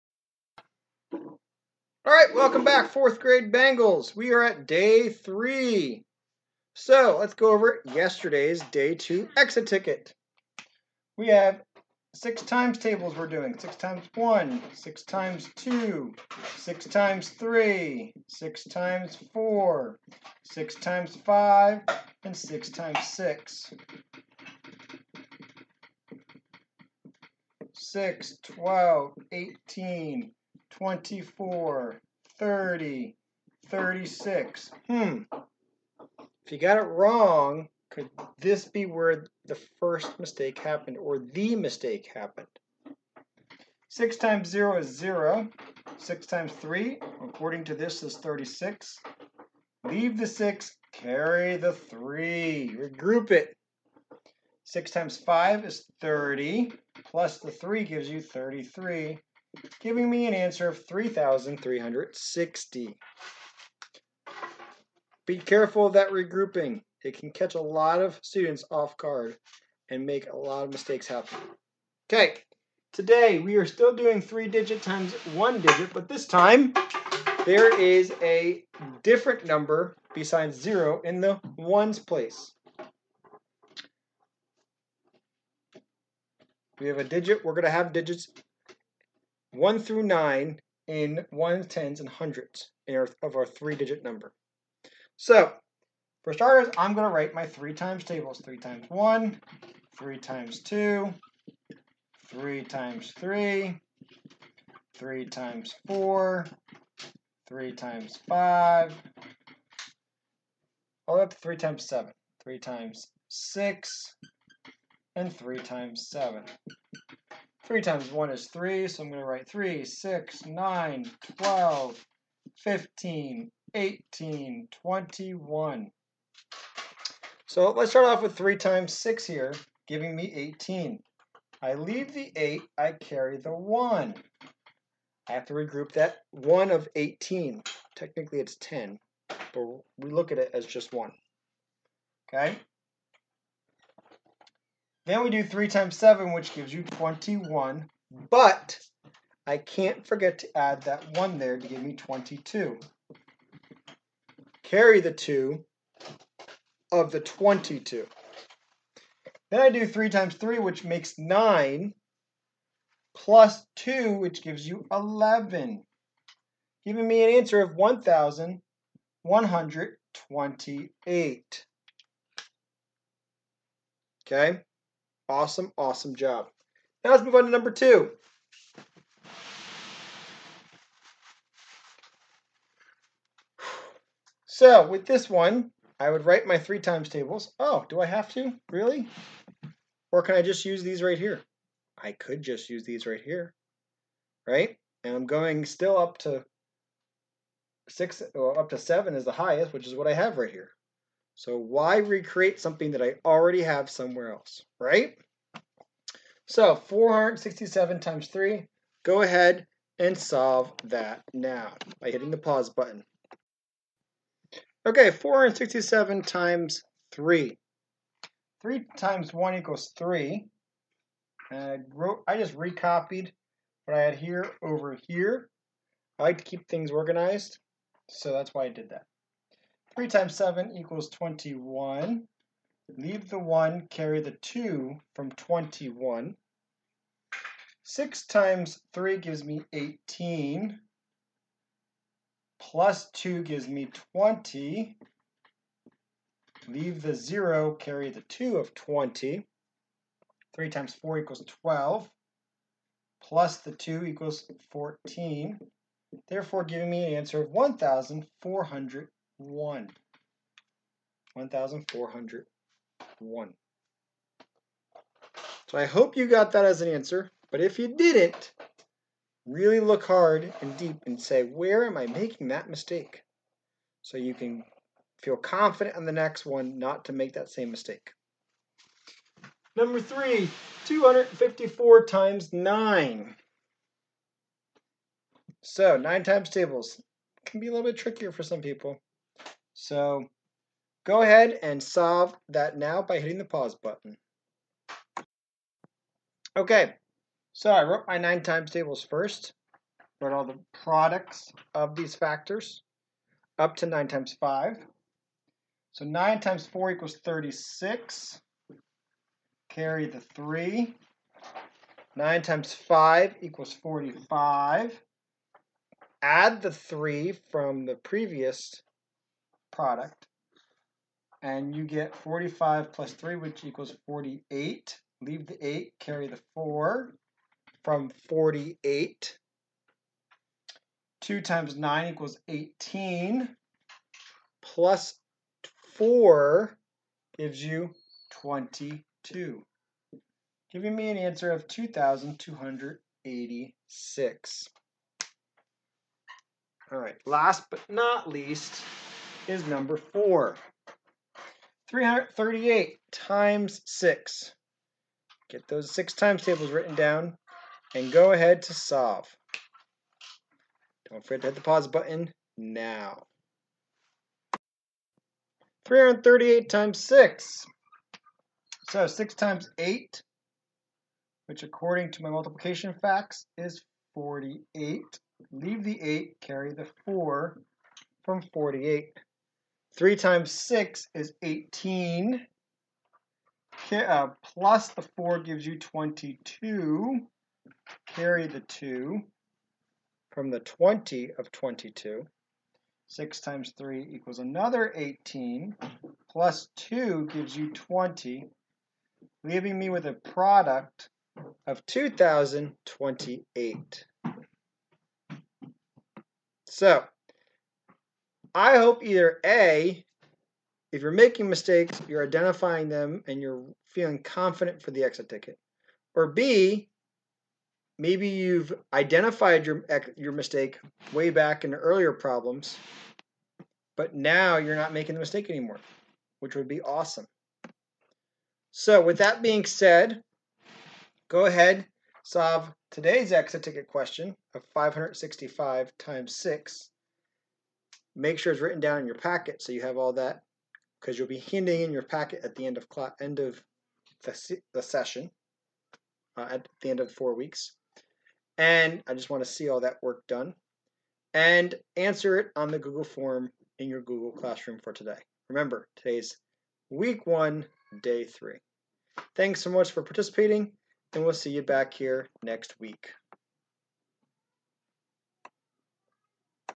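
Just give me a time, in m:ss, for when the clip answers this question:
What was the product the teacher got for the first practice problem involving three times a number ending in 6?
2:47.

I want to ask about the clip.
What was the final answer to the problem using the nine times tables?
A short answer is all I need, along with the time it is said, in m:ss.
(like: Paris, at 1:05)
2,286, at 5:41.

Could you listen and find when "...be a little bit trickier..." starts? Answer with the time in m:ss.
4:47.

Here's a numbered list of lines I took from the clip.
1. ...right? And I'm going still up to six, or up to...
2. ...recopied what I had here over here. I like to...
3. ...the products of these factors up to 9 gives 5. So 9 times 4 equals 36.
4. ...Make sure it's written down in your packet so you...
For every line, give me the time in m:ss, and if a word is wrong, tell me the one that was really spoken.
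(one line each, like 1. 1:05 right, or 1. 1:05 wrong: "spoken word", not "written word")
1. 3:14 right
2. 3:42 right
3. 5:00 wrong: "times", not "gives"
4. 7:18 right.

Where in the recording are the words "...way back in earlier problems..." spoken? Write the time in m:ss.
7:01.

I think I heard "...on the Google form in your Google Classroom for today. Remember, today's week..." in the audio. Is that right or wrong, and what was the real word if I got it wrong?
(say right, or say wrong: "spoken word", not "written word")
right.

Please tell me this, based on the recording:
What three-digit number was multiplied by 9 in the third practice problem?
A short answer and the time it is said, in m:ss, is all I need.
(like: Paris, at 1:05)
254, at 4:40.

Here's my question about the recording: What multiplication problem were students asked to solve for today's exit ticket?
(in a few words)
565 times 6.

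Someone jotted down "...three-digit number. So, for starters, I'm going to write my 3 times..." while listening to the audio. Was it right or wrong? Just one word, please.
right.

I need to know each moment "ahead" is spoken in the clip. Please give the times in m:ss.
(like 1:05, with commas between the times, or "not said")
3:29, 4:51, 5:58, 7:11.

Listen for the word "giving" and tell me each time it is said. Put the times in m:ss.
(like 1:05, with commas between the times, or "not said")
0:59, 2:09, 2:46, 4:16, 5:40.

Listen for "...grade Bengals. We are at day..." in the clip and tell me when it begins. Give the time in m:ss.
0:03.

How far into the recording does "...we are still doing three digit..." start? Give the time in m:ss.
1:13.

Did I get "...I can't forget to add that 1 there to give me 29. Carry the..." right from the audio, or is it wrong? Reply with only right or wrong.
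wrong.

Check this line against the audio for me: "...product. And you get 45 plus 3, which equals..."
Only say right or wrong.
right.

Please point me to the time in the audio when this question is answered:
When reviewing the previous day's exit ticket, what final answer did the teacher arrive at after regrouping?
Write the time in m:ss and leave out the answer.
1:00.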